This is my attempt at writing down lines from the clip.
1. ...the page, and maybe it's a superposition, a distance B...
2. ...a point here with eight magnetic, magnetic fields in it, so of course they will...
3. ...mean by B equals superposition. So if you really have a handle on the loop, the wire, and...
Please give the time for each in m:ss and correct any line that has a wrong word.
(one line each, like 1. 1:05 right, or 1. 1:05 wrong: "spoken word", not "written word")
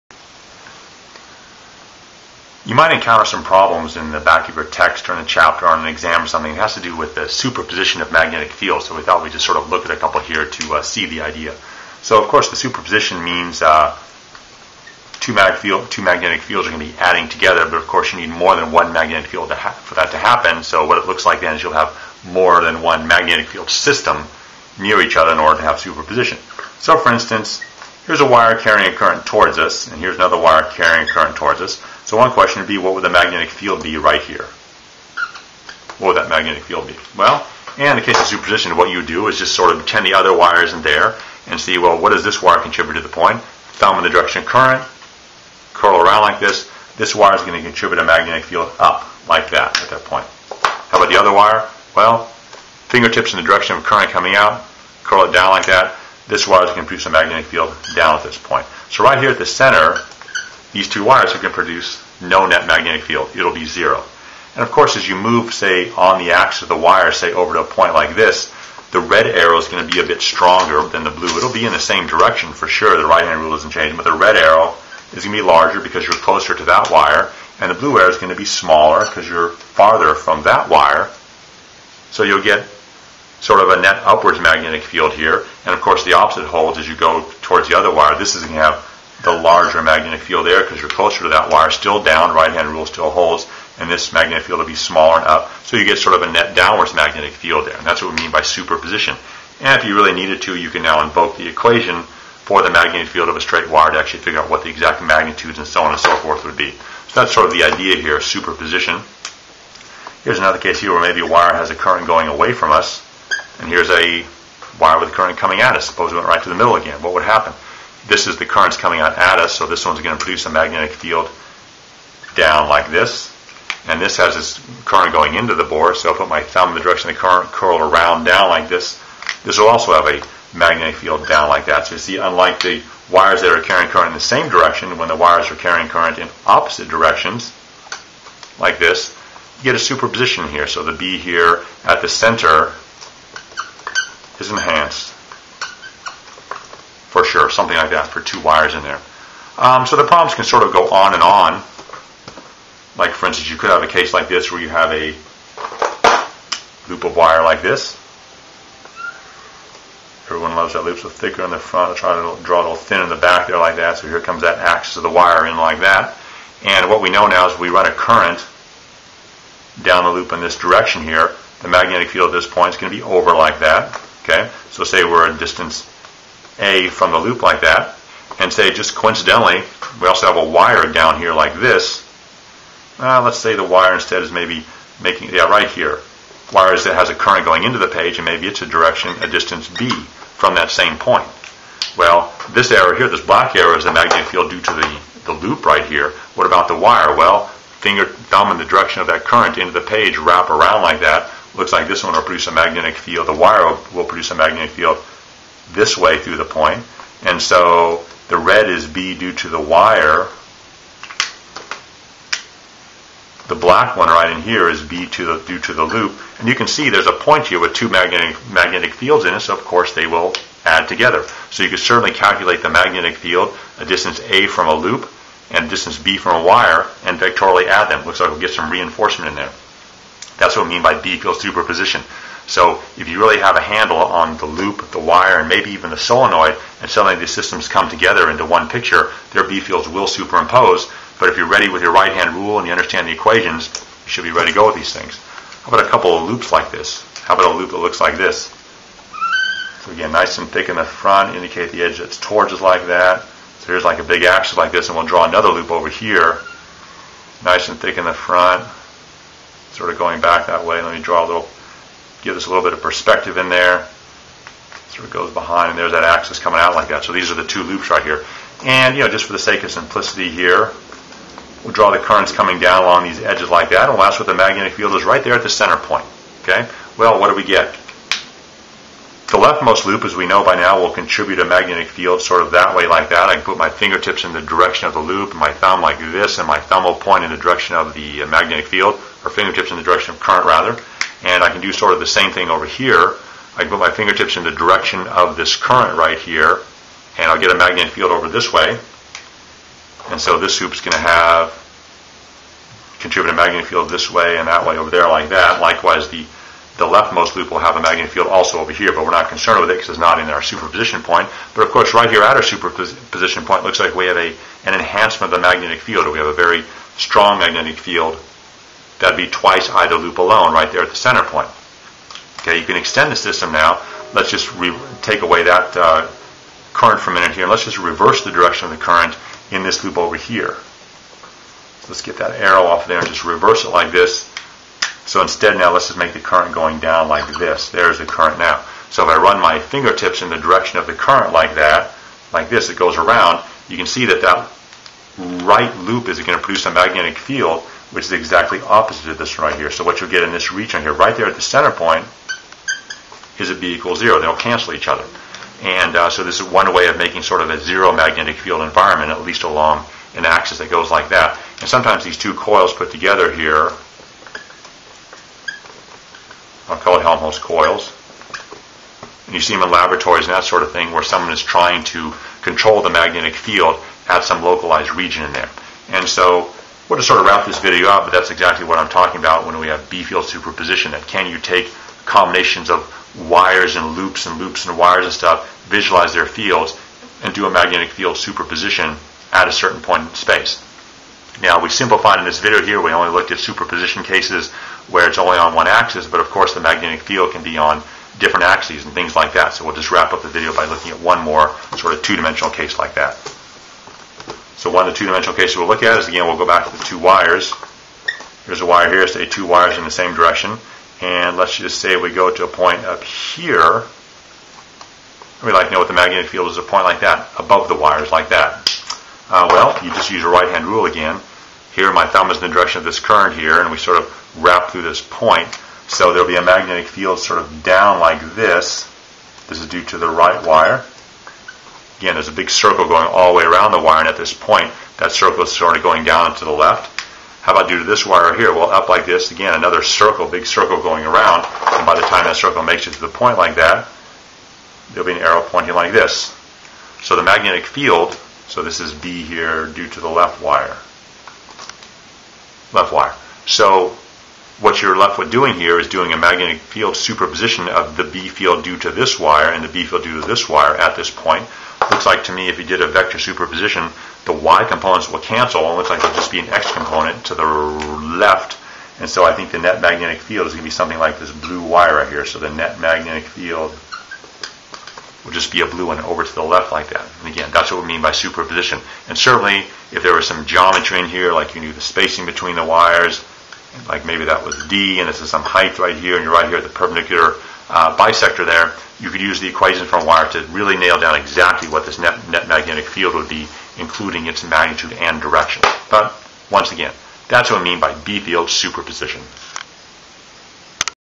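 1. 3:07 wrong: "direction", not "superposition"
2. 3:37 wrong: "two", not "eight"
3. 3:50 right.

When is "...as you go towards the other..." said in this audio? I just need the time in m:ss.
1:26.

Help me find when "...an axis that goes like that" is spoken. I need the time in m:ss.
6:00.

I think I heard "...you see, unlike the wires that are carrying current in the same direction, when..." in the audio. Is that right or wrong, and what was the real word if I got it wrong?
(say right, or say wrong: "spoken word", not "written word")
right.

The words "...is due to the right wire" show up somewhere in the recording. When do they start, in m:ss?
7:09.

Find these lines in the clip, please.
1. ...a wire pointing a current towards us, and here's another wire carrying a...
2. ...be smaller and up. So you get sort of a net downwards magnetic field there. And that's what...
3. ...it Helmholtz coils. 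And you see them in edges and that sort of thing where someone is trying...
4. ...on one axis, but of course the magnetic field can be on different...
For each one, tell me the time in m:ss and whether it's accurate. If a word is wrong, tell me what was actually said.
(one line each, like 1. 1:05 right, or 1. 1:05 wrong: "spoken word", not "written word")
1. 0:28 wrong: "carrying", not "pointing"
2. 1:34 right
3. 6:06 wrong: "laboratories", not "edges"
4. 6:35 right.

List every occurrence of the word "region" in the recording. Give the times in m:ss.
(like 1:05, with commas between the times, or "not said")
5:50, 6:14.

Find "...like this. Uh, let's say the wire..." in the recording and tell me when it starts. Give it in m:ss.
3:01.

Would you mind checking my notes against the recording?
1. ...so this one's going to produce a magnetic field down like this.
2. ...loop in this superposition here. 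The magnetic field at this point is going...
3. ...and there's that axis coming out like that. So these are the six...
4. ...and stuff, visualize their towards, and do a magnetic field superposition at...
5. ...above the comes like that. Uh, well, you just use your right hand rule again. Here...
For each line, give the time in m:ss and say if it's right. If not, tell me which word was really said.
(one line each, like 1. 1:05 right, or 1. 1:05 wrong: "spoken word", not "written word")
1. 1:59 right
2. 2:50 wrong: "direction", not "superposition"
3. 4:25 wrong: "two", not "six"
4. 6:25 wrong: "fields", not "towards"
5. 6:57 wrong: "wires", not "comes".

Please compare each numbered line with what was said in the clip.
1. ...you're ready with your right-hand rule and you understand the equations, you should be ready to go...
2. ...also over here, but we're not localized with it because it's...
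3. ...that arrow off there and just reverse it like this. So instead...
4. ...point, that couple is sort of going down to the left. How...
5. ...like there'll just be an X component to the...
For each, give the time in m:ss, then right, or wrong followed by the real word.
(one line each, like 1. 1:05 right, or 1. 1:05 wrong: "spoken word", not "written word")
1. 4:01 right
2. 5:08 wrong: "concerned", not "localized"
3. 5:32 right
4. 7:14 wrong: "circle", not "couple"
5. 7:45 right.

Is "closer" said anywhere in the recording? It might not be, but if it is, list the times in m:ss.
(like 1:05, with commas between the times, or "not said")
1:16, 1:30.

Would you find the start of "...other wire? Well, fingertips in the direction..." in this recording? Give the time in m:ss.
0:51.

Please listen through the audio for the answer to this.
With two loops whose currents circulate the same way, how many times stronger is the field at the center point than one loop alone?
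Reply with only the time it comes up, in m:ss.
5:19.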